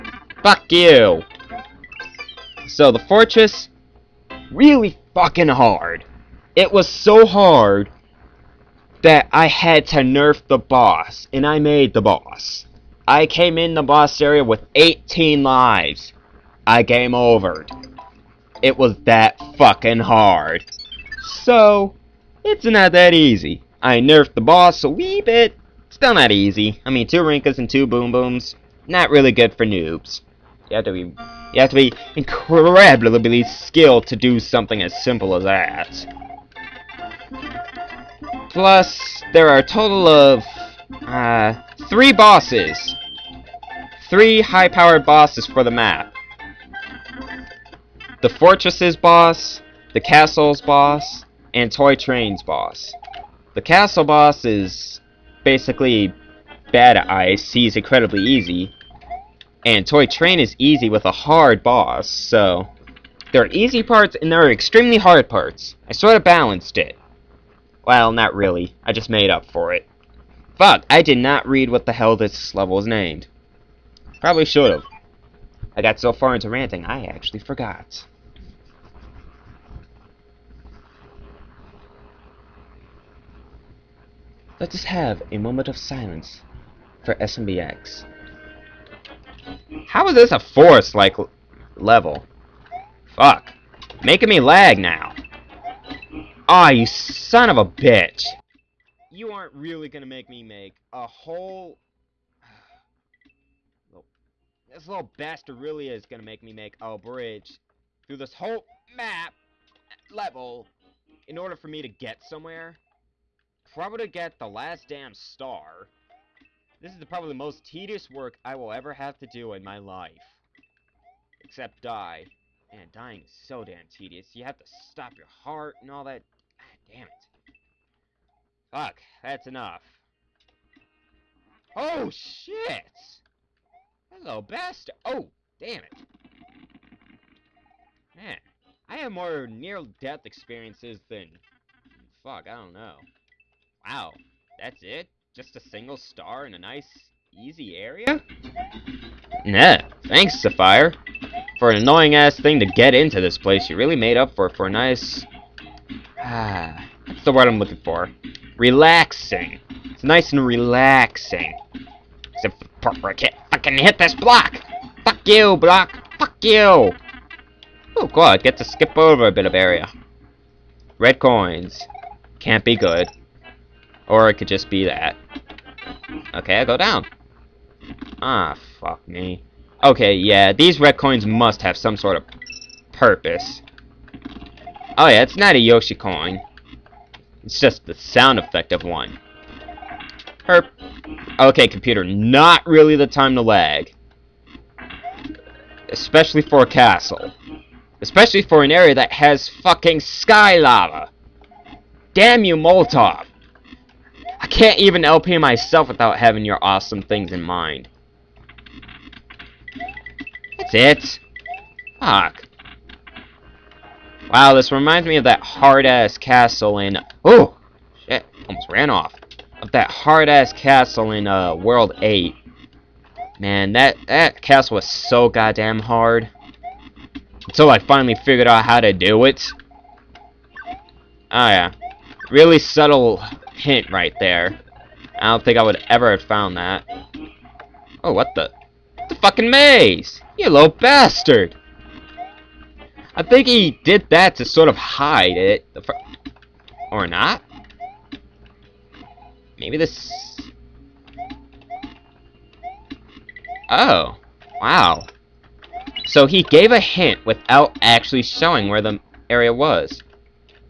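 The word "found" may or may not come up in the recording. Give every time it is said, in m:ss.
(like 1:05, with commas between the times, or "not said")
3:56.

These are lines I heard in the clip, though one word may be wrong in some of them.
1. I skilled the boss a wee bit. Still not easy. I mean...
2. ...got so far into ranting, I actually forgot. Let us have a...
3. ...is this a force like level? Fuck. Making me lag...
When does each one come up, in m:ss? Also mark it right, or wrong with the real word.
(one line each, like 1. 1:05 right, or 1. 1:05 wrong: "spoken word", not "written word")
1. 0:23 wrong: "nerfed", not "skilled"
2. 1:15 right
3. 1:30 right.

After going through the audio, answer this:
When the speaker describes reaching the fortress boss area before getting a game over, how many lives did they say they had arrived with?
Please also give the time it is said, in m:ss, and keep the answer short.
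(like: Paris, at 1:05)
18, at 0:14.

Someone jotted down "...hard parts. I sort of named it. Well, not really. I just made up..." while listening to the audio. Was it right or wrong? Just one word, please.
wrong.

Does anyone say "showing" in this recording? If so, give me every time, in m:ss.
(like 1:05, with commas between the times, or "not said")
4:18.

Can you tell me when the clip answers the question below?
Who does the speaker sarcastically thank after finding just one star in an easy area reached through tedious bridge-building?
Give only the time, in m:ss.
2:30.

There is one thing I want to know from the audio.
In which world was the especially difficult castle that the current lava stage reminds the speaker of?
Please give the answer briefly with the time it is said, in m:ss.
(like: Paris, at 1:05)
World 8, at 3:41.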